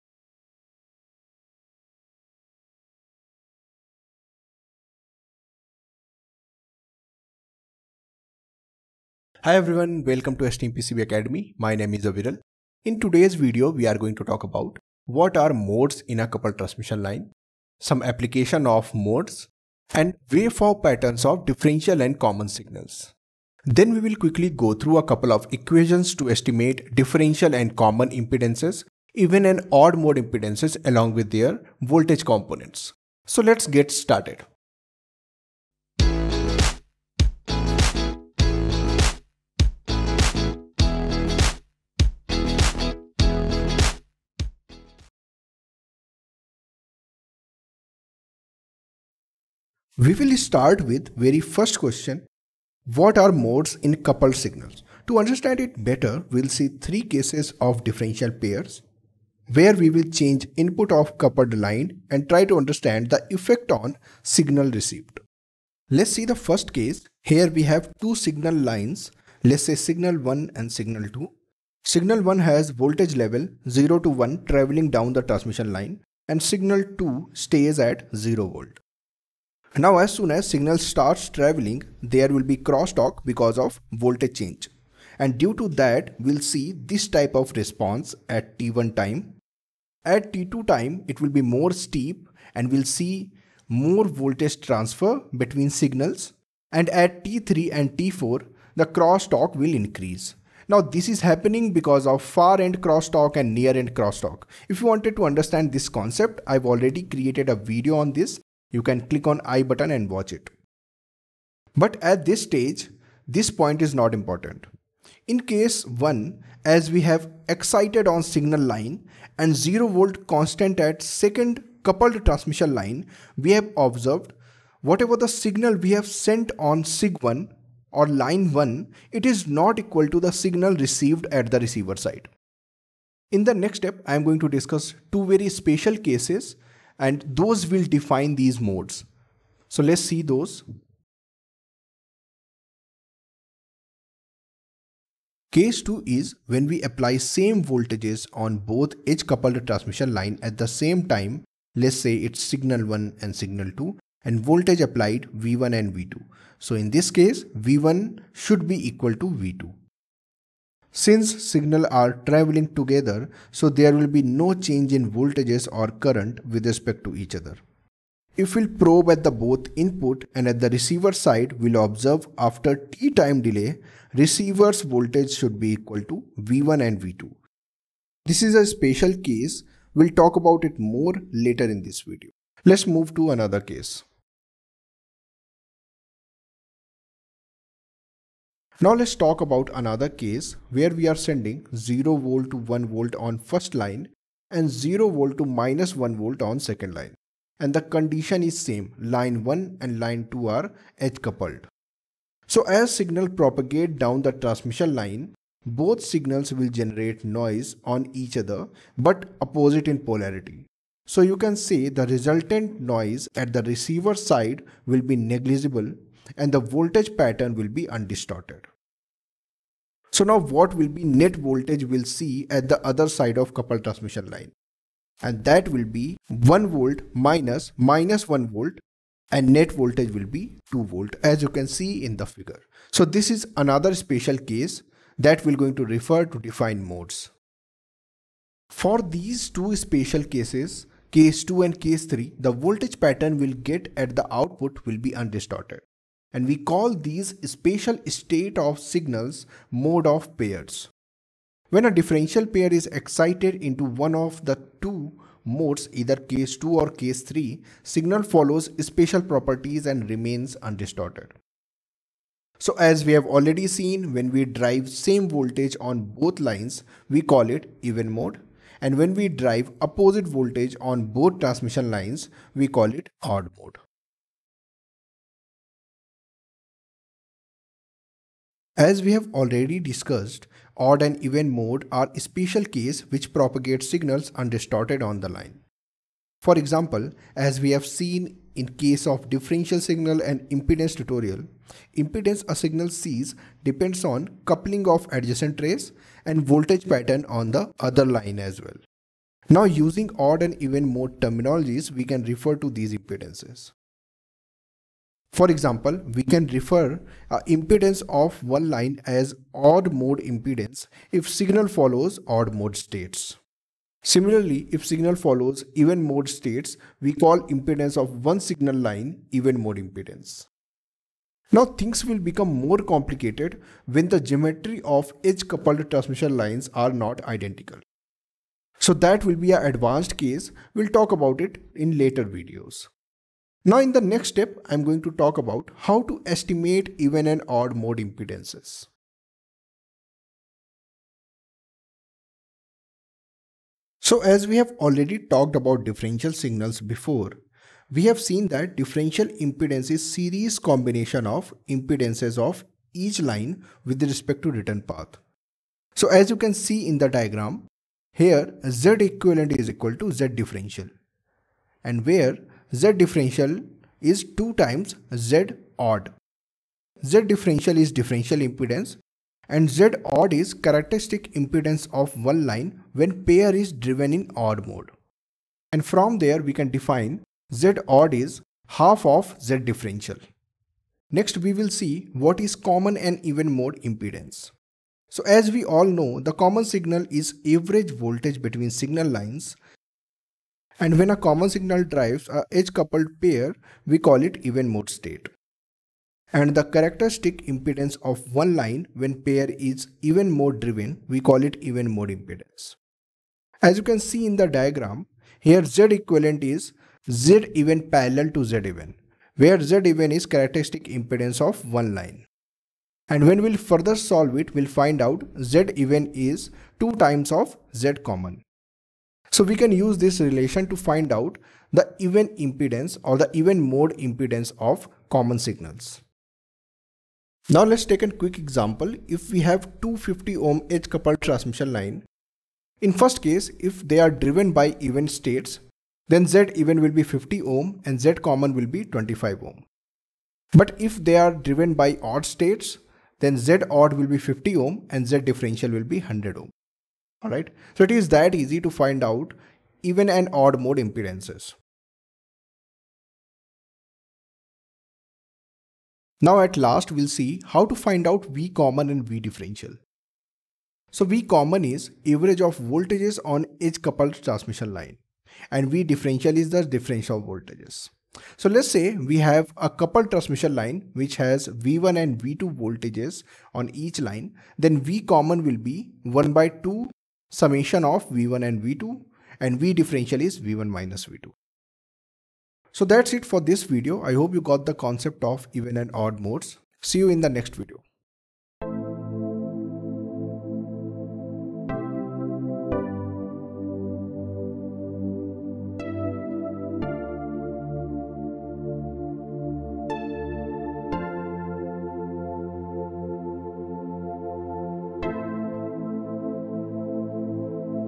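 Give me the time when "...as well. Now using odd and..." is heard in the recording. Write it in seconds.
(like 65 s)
298 s.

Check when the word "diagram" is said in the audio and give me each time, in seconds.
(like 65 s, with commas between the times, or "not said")
357 s, 404 s.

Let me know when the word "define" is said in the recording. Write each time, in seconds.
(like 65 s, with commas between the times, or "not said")
137 s, 236 s, 376 s.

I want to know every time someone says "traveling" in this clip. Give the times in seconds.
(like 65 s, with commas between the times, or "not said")
74 s, 81 s, 162 s.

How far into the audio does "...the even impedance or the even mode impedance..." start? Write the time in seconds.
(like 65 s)
421 s.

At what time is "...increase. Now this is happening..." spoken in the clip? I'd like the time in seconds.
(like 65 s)
99 s.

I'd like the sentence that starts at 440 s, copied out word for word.
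But if they are driven by odd states, then Z odd will be 50 ohm and Z differential will be 100 ohm.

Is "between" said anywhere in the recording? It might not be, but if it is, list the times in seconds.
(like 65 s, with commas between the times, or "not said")
95 s, 388 s.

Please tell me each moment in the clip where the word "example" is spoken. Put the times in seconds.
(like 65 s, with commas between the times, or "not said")
286 s, 305 s, 428 s.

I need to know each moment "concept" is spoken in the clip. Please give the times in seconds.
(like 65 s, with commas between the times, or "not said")
105 s, 484 s.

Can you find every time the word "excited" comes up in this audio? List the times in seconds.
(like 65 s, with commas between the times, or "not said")
117 s, 252 s.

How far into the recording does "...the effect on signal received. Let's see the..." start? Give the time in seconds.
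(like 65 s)
63 s.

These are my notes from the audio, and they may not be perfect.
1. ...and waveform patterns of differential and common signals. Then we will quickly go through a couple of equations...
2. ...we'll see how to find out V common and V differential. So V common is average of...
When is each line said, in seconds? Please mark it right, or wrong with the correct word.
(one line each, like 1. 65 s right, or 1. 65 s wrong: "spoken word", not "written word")
1. 19 s right
2. 456 s right.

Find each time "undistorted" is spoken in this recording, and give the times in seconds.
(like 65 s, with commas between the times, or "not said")
217 s, 245 s, 260 s, 284 s.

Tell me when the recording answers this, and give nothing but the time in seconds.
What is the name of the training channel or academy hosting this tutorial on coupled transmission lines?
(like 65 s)
10 s.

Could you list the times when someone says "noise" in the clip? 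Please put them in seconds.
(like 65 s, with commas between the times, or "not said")
207 s, 212 s.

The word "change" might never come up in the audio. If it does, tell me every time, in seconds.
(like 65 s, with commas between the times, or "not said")
60 s, 84 s, 164 s.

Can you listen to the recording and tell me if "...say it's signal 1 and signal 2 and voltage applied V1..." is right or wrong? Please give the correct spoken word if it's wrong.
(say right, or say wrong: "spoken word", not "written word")
right.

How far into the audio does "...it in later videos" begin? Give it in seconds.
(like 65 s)
331 s.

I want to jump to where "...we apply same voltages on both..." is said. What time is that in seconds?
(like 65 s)
146 s.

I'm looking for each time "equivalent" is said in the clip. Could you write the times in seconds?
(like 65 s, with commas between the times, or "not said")
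359 s, 405 s.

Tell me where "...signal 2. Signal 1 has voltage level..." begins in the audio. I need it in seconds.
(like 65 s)
70 s.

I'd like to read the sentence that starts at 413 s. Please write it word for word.
And when we'll further solve it, we'll find out Z even is 2 times of Z common.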